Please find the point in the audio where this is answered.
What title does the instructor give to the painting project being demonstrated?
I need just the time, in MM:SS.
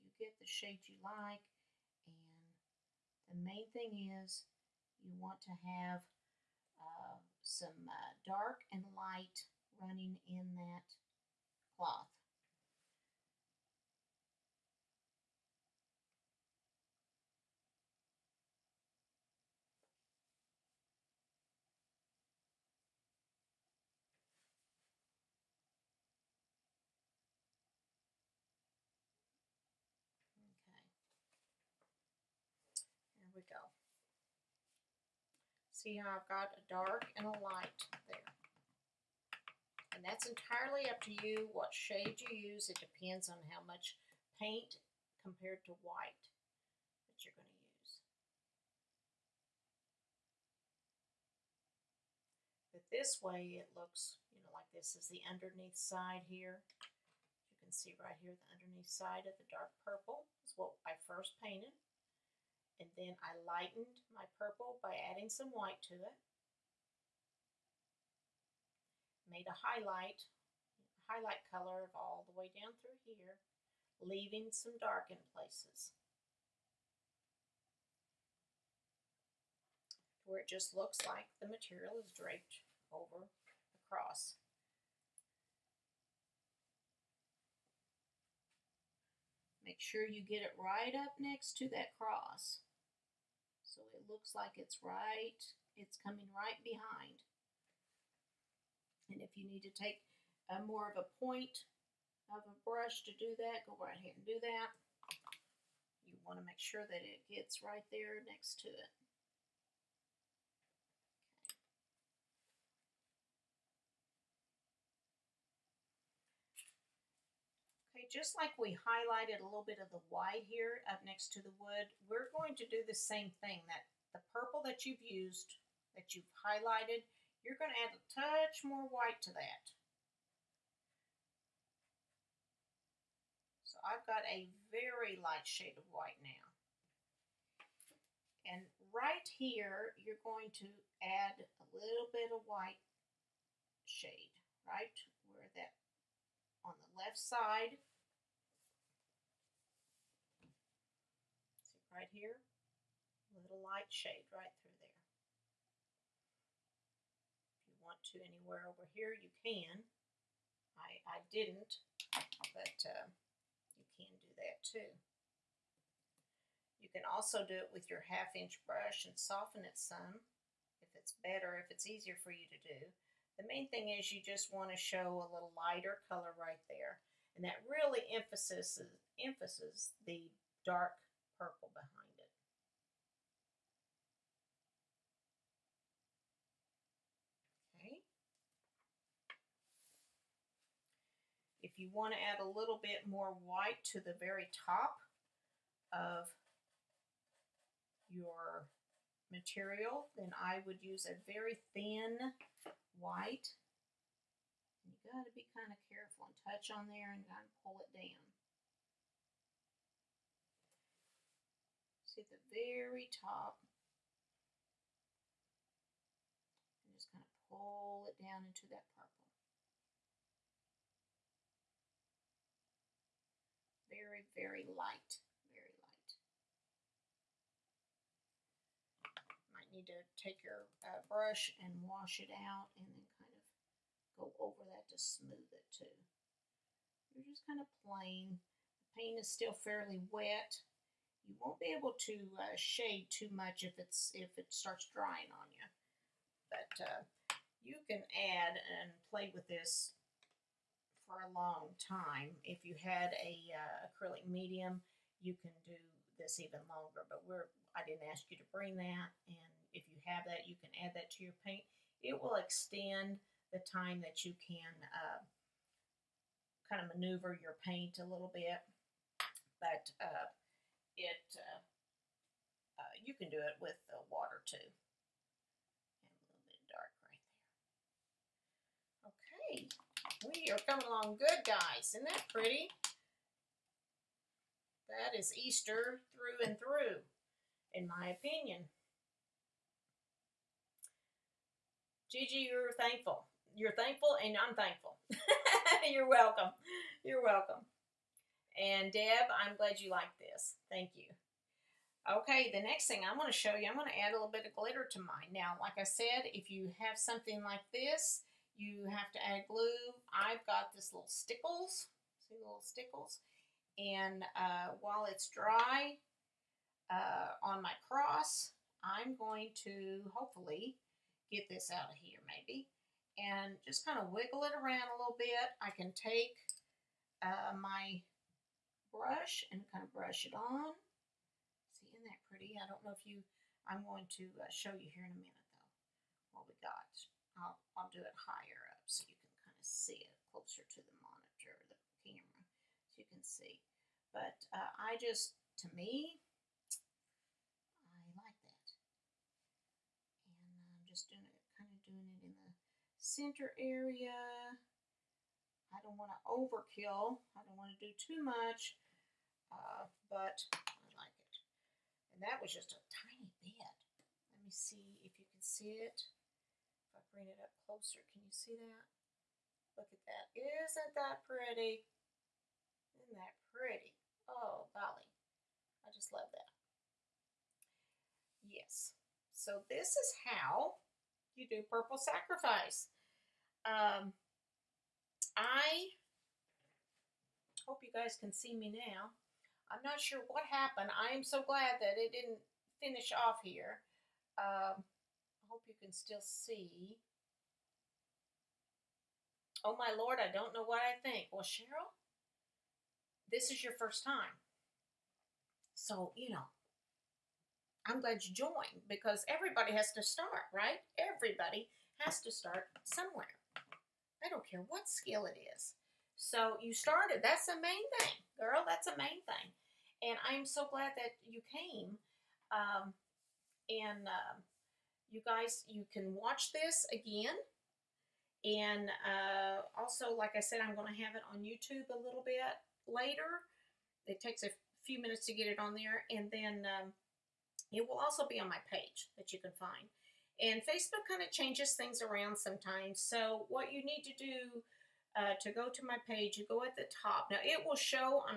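06:21.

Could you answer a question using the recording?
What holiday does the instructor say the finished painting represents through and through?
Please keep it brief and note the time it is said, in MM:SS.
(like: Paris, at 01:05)
Easter, at 04:45.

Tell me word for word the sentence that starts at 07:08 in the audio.
And uh, also, like I said, I'm going to have it on YouTube a little bit later.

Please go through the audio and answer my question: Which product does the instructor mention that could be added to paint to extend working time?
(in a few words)
acrylic medium.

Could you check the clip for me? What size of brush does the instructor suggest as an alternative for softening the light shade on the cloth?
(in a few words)
half inch.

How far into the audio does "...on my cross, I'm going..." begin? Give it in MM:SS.
05:17.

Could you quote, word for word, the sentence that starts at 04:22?
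It will extend the time that you can uh, kind of maneuver your paint a little bit.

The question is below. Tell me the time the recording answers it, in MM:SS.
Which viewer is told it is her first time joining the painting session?
06:41.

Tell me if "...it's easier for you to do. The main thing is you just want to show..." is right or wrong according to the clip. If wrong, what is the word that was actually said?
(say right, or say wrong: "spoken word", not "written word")
right.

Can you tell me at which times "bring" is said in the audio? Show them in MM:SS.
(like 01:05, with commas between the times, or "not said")
04:18, 06:07.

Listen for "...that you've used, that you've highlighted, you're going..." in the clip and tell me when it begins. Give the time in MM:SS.
02:04.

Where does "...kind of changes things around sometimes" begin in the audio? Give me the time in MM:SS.
07:21.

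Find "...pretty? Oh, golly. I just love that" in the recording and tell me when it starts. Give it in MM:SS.
06:13.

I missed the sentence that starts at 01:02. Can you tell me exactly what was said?
And then I lightened my purple by adding some white to it.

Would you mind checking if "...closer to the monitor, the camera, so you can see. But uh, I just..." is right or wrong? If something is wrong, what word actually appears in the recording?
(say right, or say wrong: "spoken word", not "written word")
right.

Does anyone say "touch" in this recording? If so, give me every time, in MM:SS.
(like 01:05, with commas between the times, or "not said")
02:08, 03:26.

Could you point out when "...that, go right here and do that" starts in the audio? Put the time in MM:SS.
01:43.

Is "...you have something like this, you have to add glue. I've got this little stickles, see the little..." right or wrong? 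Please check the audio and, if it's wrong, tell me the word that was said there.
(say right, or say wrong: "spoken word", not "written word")
right.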